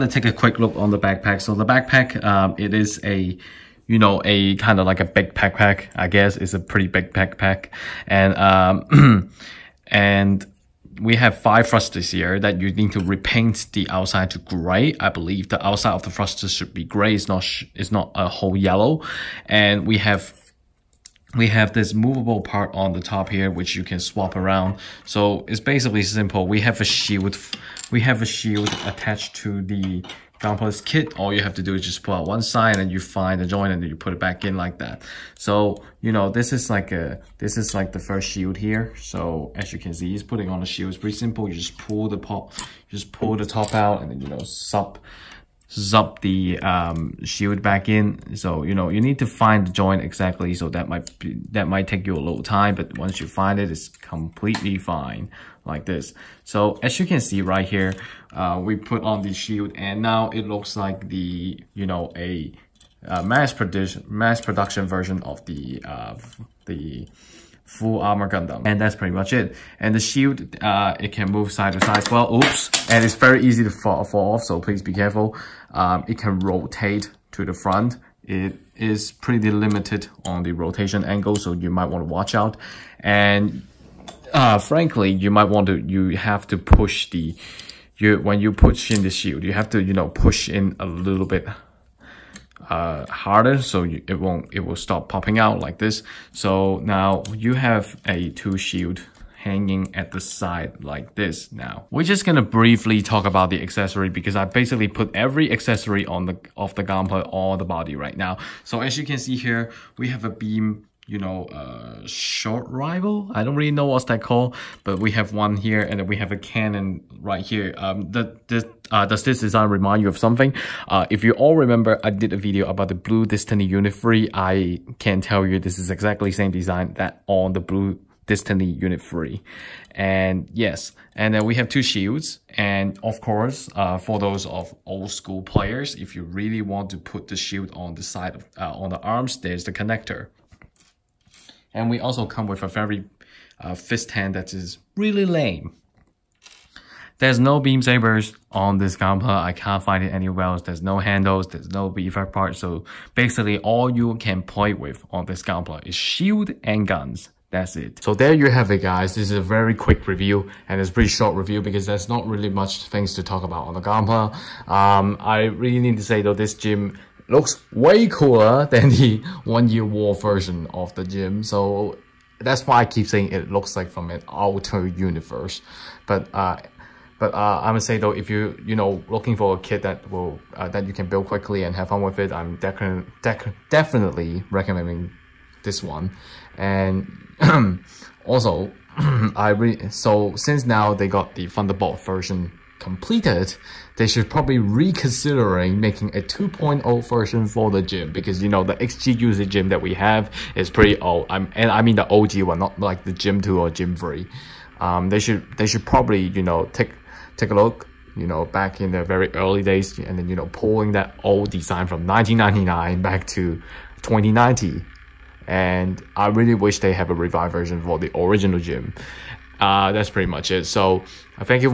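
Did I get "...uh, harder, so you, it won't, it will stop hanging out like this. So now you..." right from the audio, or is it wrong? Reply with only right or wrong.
wrong.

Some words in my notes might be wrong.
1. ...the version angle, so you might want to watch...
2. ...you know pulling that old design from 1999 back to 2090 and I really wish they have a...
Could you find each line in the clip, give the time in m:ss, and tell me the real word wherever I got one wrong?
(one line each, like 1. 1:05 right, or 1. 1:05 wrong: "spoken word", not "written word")
1. 1:20 wrong: "rotation", not "version"
2. 3:30 right.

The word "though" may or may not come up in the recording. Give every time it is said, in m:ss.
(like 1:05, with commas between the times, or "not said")
2:46, 2:57.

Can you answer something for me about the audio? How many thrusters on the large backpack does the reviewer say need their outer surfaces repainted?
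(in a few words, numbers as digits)
5.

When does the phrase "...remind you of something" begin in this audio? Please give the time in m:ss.
1:59.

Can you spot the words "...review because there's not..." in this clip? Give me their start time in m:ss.
2:41.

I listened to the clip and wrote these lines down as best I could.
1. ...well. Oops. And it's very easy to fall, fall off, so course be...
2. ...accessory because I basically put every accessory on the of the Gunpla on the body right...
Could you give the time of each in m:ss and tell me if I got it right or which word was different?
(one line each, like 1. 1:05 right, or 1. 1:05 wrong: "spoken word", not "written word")
1. 1:12 wrong: "please", not "course"
2. 1:43 right.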